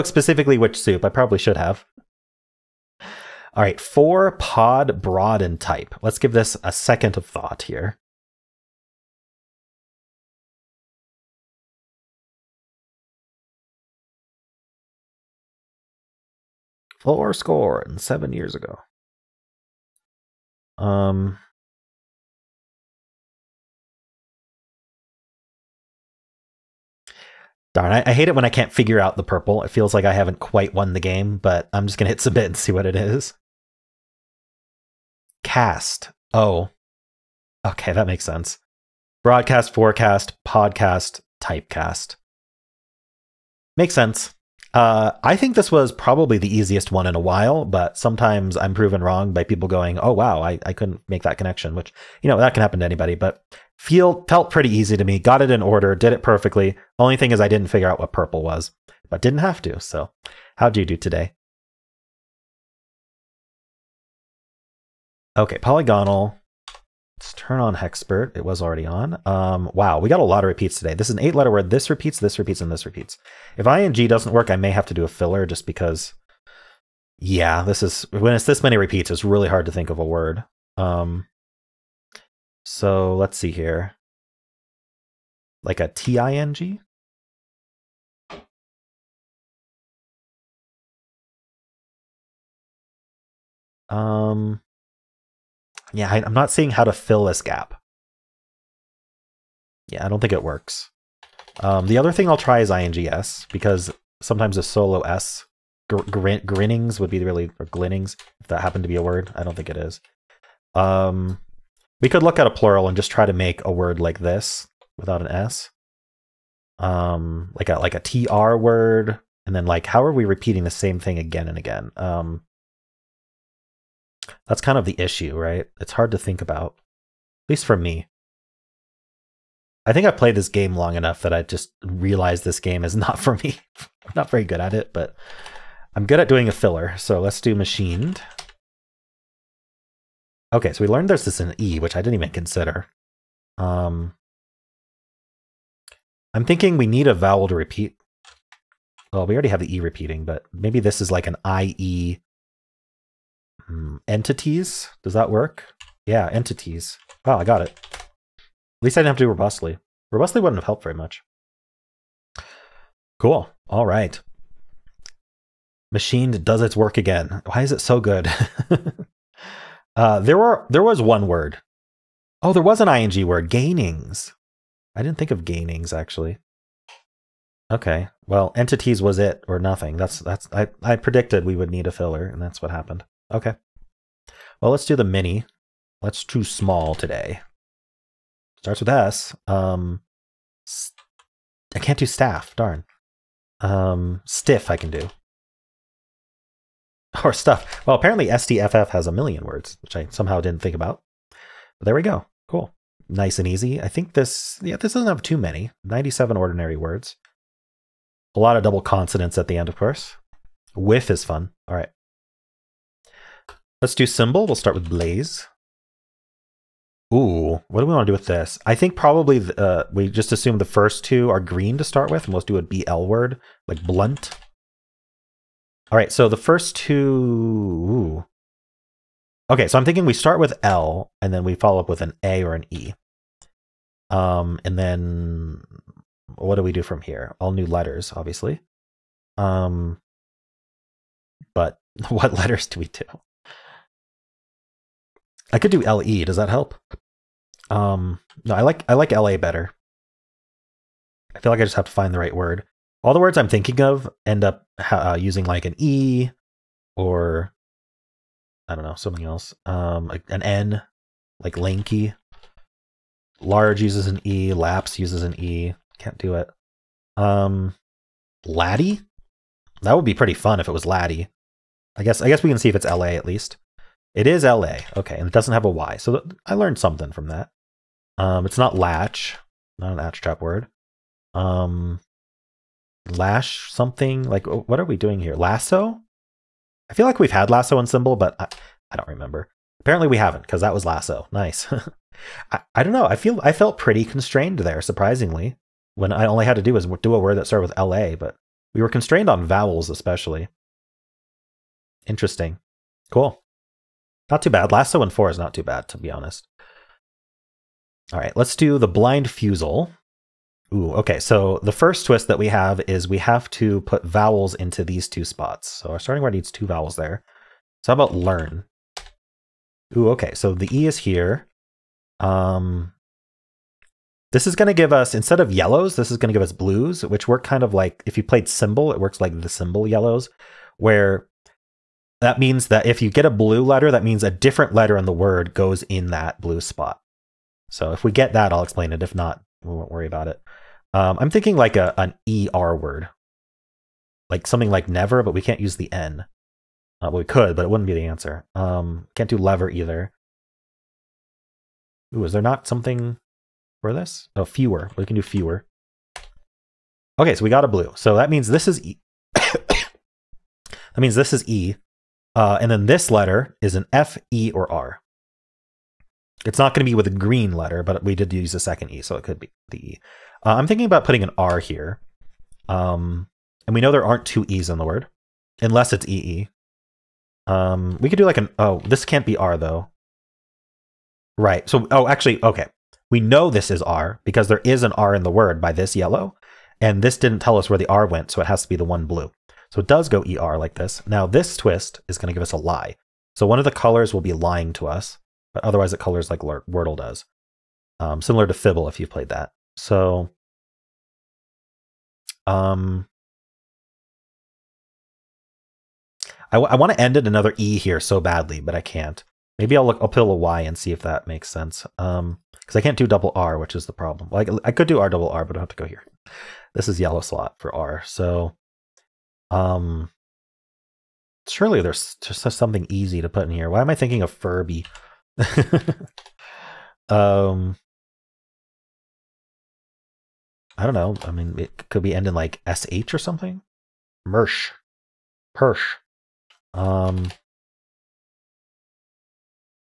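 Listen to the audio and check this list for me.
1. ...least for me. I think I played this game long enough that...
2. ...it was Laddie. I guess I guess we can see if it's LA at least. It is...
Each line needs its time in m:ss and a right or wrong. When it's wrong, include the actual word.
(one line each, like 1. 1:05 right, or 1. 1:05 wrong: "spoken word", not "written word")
1. 2:07 right
2. 4:30 right.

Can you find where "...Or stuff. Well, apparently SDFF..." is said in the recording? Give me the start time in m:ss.
3:17.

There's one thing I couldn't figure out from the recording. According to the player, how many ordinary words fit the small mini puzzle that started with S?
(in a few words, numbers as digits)
97.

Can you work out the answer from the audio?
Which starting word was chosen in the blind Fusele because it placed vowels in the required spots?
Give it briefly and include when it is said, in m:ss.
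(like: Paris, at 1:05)
learn, at 5:17.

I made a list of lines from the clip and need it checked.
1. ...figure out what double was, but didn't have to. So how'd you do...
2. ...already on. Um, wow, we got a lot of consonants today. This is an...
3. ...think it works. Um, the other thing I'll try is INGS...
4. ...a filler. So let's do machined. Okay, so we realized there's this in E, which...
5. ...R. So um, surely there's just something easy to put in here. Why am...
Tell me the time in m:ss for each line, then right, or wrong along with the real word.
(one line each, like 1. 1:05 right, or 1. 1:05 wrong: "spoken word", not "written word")
1. 0:57 wrong: "purple", not "double"
2. 1:08 wrong: "repeats", not "consonants"
3. 1:40 right
4. 2:16 wrong: "learned", not "realized"
5. 6:57 right.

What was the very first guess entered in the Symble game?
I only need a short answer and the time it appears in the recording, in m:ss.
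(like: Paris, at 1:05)
blaze, at 3:34.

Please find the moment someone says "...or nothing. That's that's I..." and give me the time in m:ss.
2:59.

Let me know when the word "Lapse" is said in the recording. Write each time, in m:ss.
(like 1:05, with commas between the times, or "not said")
4:24.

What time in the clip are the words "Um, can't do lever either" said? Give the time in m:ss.
5:48.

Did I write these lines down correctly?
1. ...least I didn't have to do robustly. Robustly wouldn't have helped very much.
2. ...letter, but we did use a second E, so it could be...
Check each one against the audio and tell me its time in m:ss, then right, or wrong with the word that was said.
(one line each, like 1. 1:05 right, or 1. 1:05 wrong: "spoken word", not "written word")
1. 2:38 right
2. 6:07 right.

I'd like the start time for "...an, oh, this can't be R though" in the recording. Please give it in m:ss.
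6:18.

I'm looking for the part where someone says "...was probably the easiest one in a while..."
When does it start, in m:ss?
0:45.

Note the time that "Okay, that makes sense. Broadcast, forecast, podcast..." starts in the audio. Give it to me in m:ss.
0:37.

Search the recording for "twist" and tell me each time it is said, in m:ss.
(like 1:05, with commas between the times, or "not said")
5:12, 6:31.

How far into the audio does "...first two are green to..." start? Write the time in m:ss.
3:40.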